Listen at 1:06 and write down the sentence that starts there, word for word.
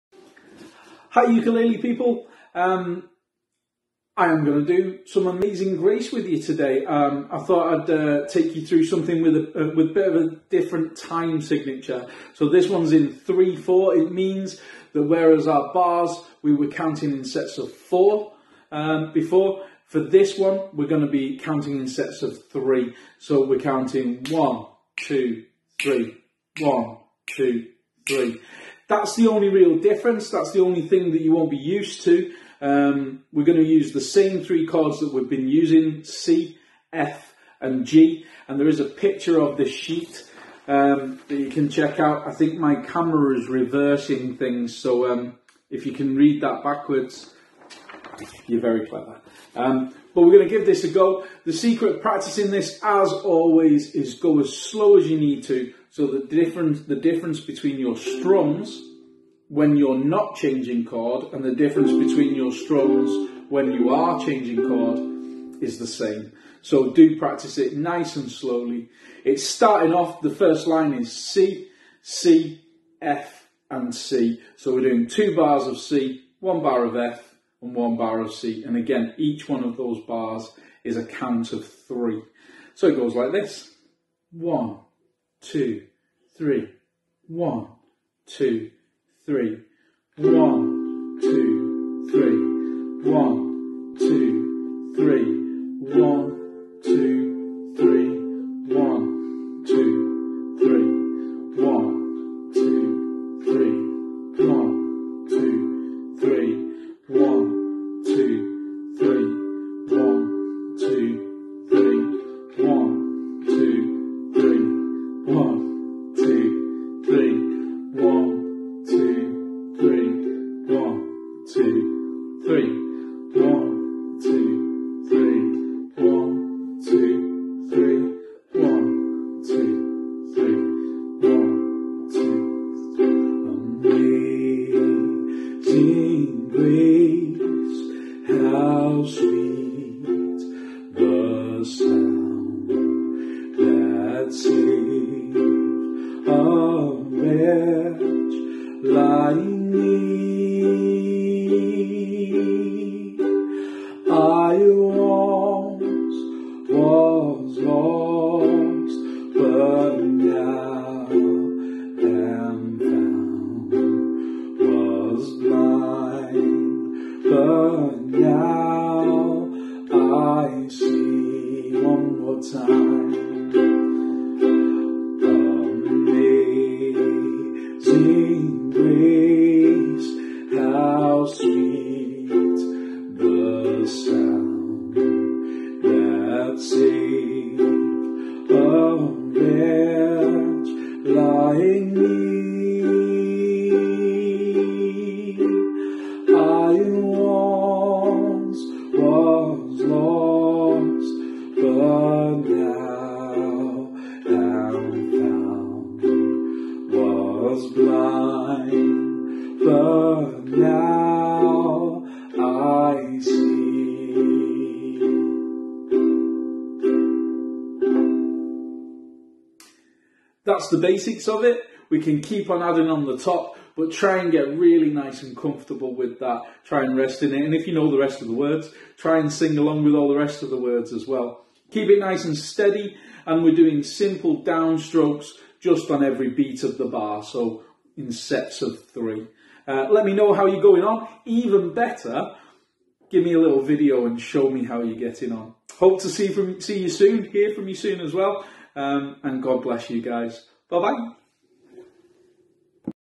So do practice it nice and slowly.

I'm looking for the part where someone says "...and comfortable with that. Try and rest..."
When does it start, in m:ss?
3:45.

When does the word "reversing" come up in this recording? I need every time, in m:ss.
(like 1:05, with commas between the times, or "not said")
0:43.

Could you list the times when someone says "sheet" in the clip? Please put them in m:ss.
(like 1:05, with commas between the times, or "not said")
0:39.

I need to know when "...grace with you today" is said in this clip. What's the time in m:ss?
0:05.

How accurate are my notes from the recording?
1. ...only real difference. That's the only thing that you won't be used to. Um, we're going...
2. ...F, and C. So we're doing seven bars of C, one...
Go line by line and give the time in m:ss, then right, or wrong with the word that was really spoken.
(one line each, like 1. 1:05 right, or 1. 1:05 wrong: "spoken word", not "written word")
1. 0:29 right
2. 1:13 wrong: "two", not "seven".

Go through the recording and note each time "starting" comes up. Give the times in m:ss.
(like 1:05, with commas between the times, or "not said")
1:09.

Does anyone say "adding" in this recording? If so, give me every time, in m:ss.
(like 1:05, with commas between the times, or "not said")
3:42.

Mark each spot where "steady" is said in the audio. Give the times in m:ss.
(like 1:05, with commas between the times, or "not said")
3:52.